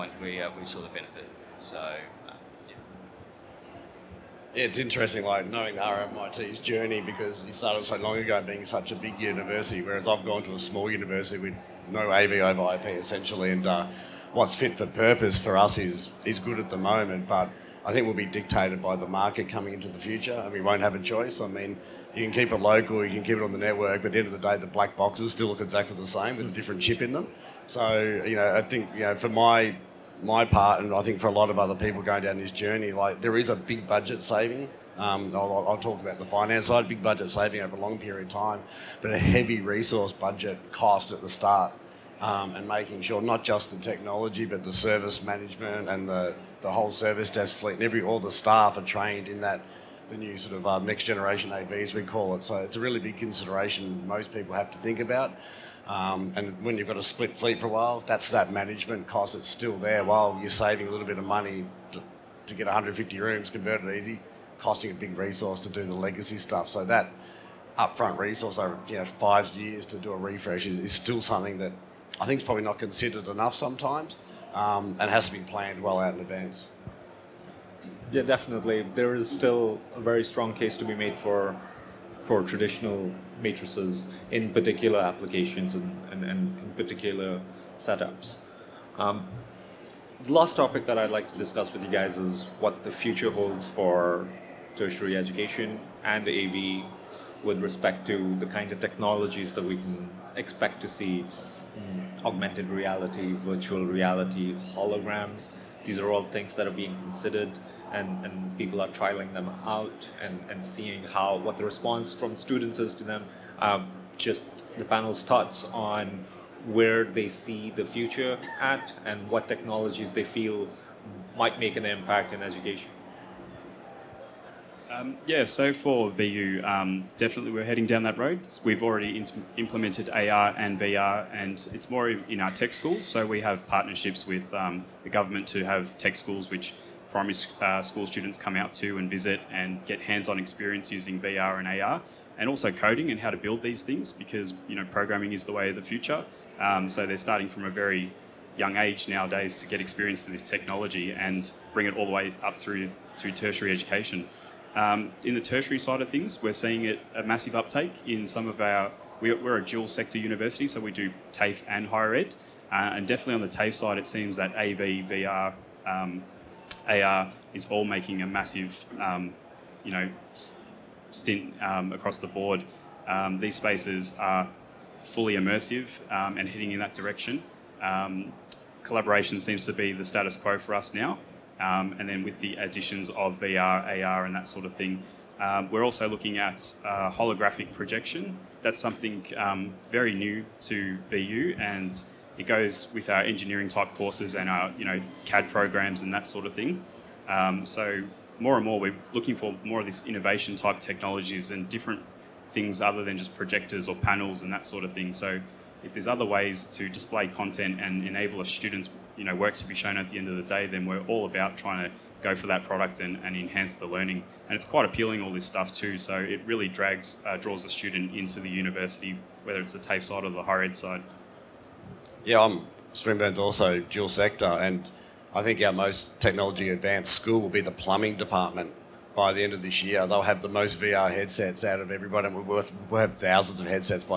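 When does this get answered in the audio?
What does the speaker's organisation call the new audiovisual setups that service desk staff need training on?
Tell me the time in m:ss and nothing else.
0:50.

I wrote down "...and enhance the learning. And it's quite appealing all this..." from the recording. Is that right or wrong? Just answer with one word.
right.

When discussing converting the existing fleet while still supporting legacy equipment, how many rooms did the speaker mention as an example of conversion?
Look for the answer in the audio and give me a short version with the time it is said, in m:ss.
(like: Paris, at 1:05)
150, at 1:02.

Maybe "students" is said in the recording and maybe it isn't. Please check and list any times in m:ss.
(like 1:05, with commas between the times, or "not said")
1:52, 2:18, 3:28, 3:37.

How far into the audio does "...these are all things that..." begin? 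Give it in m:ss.
1:45.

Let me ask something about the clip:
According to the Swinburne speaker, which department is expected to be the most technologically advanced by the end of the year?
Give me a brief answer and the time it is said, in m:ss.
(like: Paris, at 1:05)
plumbing department, at 3:47.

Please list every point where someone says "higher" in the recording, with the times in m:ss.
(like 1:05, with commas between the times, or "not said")
2:41, 3:40.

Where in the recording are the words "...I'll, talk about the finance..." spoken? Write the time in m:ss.
0:35.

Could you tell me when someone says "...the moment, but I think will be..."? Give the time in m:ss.
0:16.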